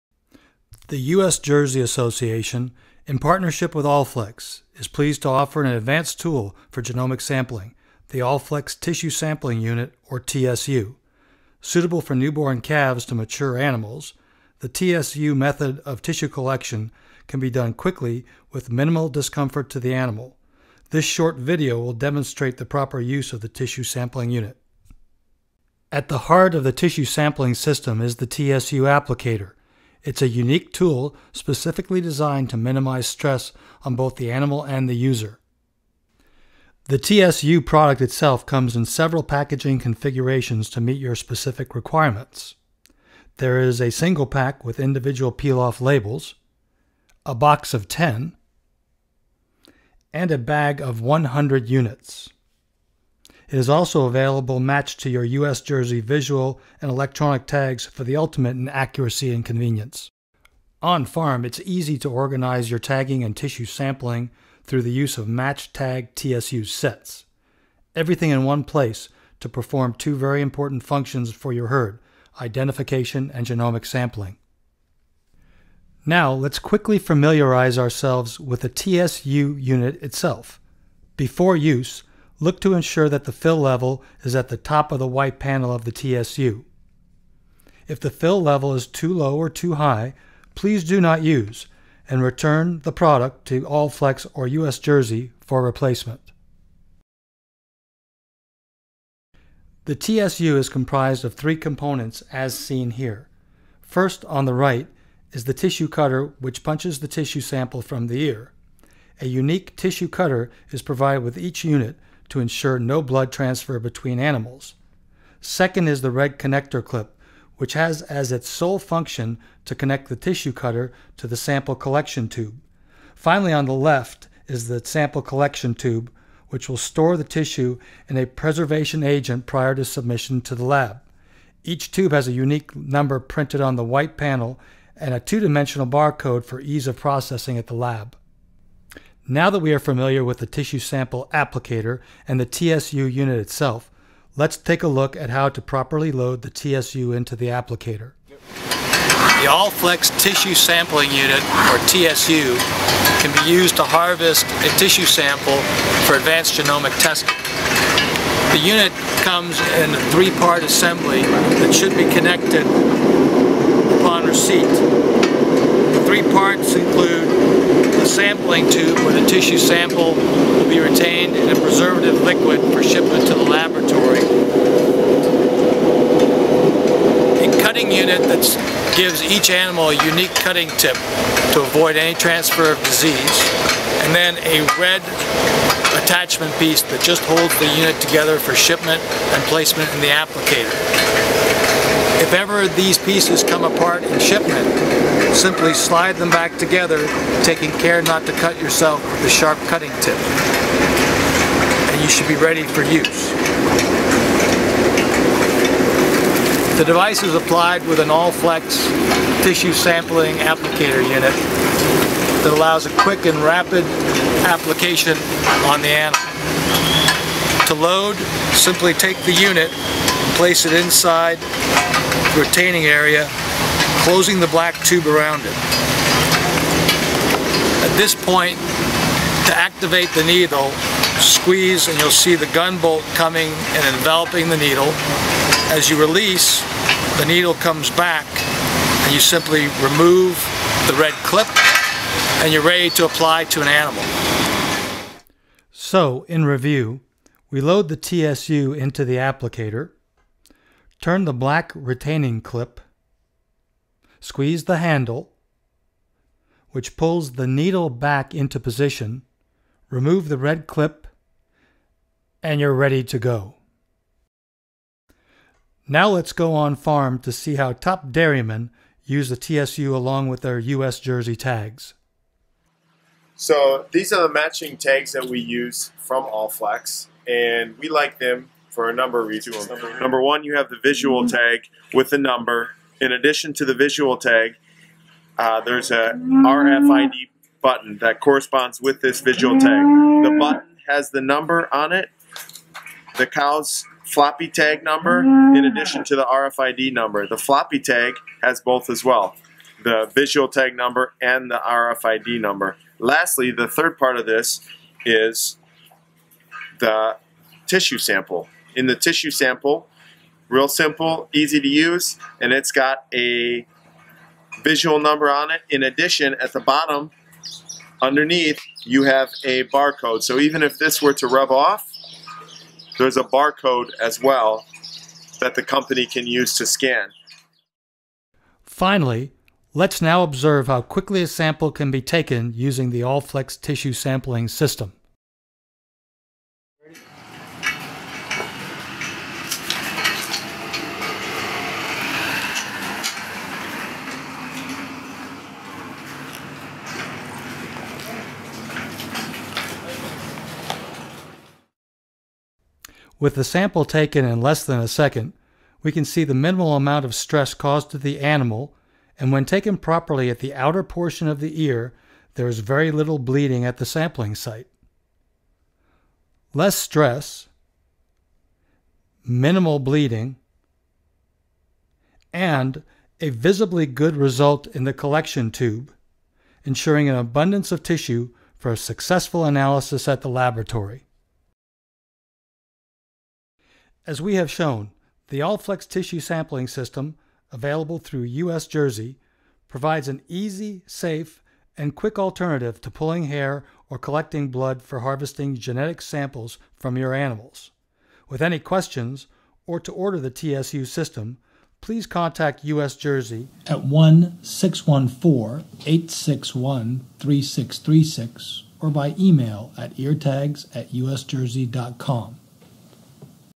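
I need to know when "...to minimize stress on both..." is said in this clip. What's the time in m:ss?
0:32.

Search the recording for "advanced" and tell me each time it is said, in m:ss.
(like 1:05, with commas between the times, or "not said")
0:05, 2:36.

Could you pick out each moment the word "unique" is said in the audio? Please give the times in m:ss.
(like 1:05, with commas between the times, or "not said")
0:30, 1:49, 2:12, 3:00.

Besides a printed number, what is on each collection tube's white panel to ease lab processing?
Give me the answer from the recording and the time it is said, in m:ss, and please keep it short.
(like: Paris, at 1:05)
two-dimensional barcode, at 2:15.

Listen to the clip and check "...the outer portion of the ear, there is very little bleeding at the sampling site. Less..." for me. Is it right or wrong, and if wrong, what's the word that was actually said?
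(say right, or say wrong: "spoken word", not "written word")
right.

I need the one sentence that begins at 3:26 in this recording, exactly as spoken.
The device is applied with an all-flex tissue sampling applicator unit that allows a quick and rapid application on the animal.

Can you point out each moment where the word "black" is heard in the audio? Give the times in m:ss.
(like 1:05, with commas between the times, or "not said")
3:44, 4:11.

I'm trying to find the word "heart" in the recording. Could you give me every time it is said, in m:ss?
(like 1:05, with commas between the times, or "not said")
0:26.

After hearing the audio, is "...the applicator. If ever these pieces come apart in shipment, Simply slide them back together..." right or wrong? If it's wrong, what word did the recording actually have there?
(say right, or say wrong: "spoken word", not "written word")
right.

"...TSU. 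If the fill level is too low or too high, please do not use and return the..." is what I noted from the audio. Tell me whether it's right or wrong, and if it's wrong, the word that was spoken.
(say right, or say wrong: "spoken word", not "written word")
right.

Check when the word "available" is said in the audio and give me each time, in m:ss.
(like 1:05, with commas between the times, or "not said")
0:54, 6:27.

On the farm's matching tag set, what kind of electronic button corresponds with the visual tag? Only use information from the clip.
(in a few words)
RFID button.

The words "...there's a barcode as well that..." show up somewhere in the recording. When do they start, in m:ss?
5:22.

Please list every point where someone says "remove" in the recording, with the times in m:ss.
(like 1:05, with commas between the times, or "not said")
3:59, 4:19.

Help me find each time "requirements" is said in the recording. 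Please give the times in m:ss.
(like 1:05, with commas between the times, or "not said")
0:41.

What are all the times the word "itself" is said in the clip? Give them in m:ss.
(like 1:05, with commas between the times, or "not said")
0:38, 1:20, 2:23.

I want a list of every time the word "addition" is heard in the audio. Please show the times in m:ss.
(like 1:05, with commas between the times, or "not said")
4:43, 4:55, 5:15.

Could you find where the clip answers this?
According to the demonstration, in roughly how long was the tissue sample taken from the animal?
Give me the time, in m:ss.
5:54.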